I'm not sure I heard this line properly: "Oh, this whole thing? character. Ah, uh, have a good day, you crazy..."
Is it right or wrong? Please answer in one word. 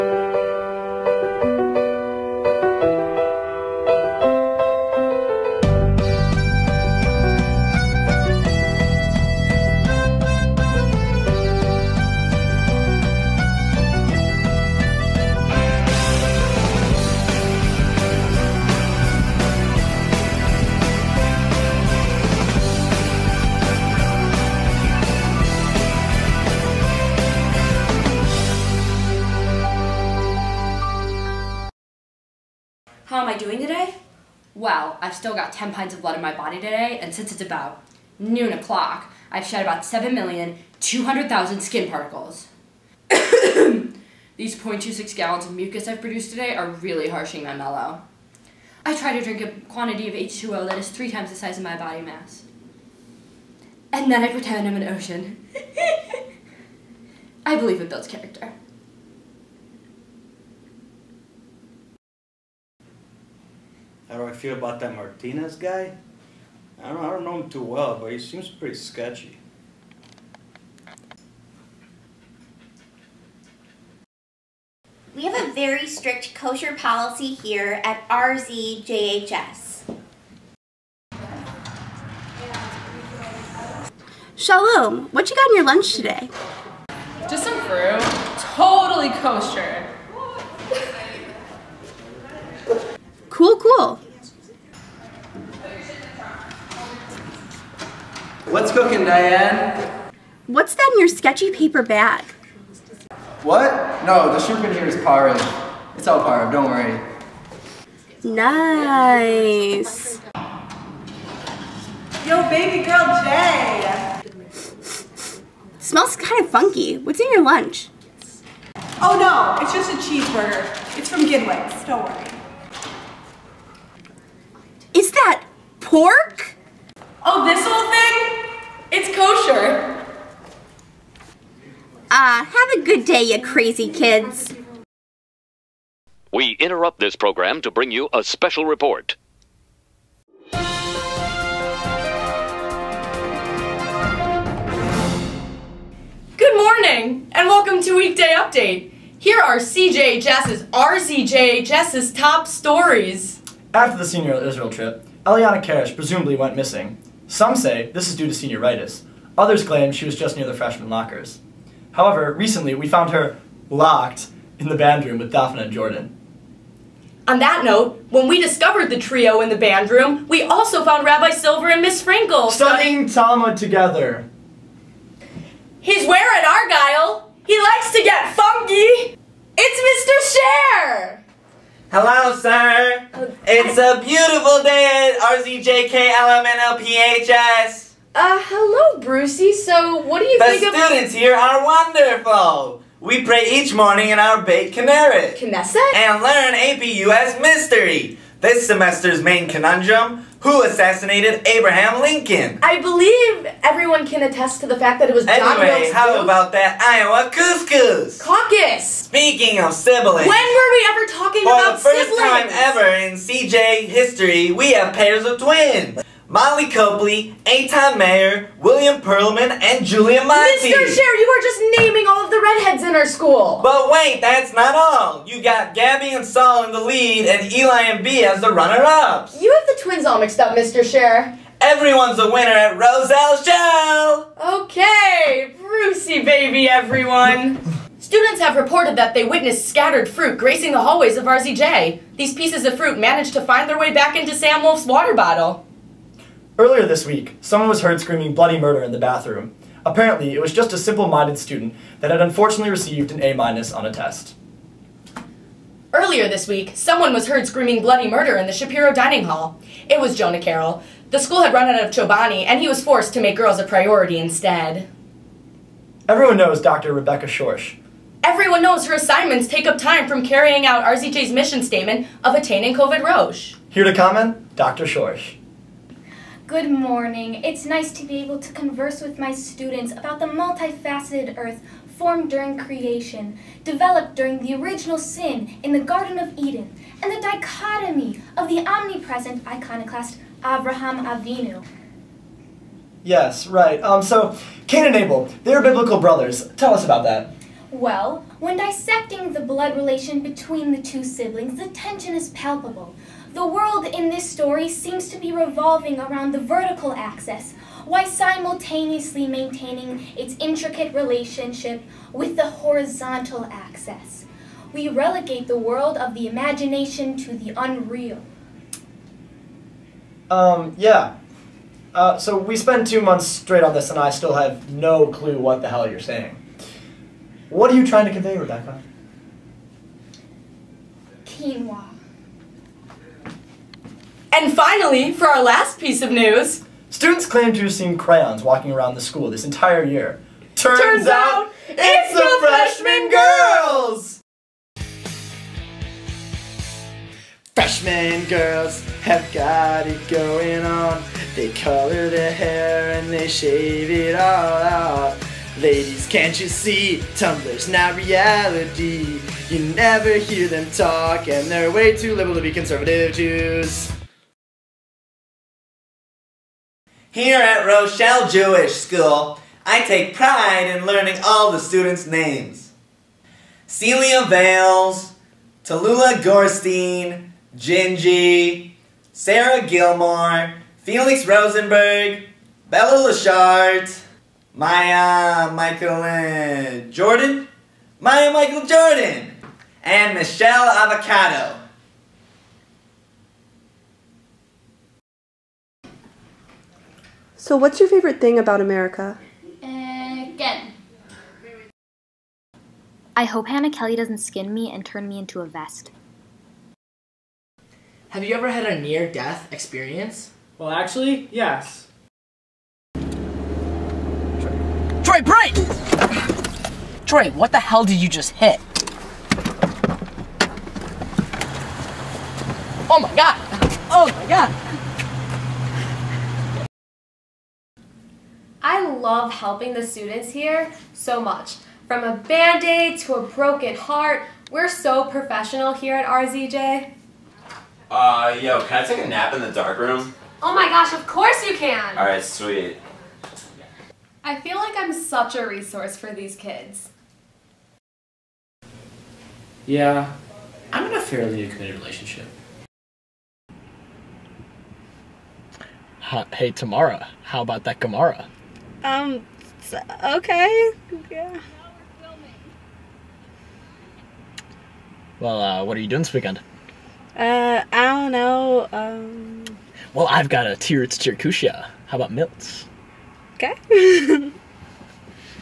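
wrong.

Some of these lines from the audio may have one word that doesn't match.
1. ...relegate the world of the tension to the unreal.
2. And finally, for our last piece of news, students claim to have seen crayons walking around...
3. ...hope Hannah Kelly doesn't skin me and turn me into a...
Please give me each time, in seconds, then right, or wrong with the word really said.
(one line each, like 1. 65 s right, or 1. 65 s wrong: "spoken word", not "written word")
1. 314 s wrong: "imagination", not "tension"
2. 334 s right
3. 403 s right.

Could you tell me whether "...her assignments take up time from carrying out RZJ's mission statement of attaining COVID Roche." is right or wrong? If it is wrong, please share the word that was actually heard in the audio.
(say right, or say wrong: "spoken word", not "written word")
right.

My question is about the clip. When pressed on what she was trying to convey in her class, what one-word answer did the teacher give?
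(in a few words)
Quinoa.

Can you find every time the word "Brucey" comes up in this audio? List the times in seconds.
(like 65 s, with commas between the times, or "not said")
188 s, 235 s.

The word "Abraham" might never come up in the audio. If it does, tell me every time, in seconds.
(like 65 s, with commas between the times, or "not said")
201 s, 290 s.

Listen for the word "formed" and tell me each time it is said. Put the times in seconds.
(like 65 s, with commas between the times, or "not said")
281 s.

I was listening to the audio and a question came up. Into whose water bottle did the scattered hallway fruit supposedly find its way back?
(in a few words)
Sam Wolf.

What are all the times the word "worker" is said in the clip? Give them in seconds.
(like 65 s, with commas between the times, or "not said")
not said.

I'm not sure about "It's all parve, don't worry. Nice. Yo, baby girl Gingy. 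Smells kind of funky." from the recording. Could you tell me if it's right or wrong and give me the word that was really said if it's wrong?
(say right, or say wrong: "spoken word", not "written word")
wrong: "Jay", not "Gingy".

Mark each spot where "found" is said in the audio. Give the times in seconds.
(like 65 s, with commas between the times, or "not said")
162 s, 170 s.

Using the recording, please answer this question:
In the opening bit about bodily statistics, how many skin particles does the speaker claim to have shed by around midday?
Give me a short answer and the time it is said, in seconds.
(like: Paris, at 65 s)
7,200,000, at 39 s.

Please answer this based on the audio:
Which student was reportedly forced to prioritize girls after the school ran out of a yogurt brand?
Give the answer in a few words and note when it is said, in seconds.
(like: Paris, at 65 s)
Jonah Carroll, at 260 s.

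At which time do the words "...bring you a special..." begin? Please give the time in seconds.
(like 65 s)
137 s.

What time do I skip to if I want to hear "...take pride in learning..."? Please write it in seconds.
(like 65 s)
369 s.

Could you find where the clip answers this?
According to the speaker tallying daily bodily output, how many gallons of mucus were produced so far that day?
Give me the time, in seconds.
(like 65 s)
44 s.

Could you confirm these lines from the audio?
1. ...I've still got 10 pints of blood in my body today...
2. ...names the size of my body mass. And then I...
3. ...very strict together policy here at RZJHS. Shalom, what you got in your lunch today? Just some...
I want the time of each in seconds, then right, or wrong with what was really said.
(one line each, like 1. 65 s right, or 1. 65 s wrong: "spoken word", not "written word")
1. 35 s right
2. 51 s wrong: "times", not "names"
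3. 75 s wrong: "kosher", not "together".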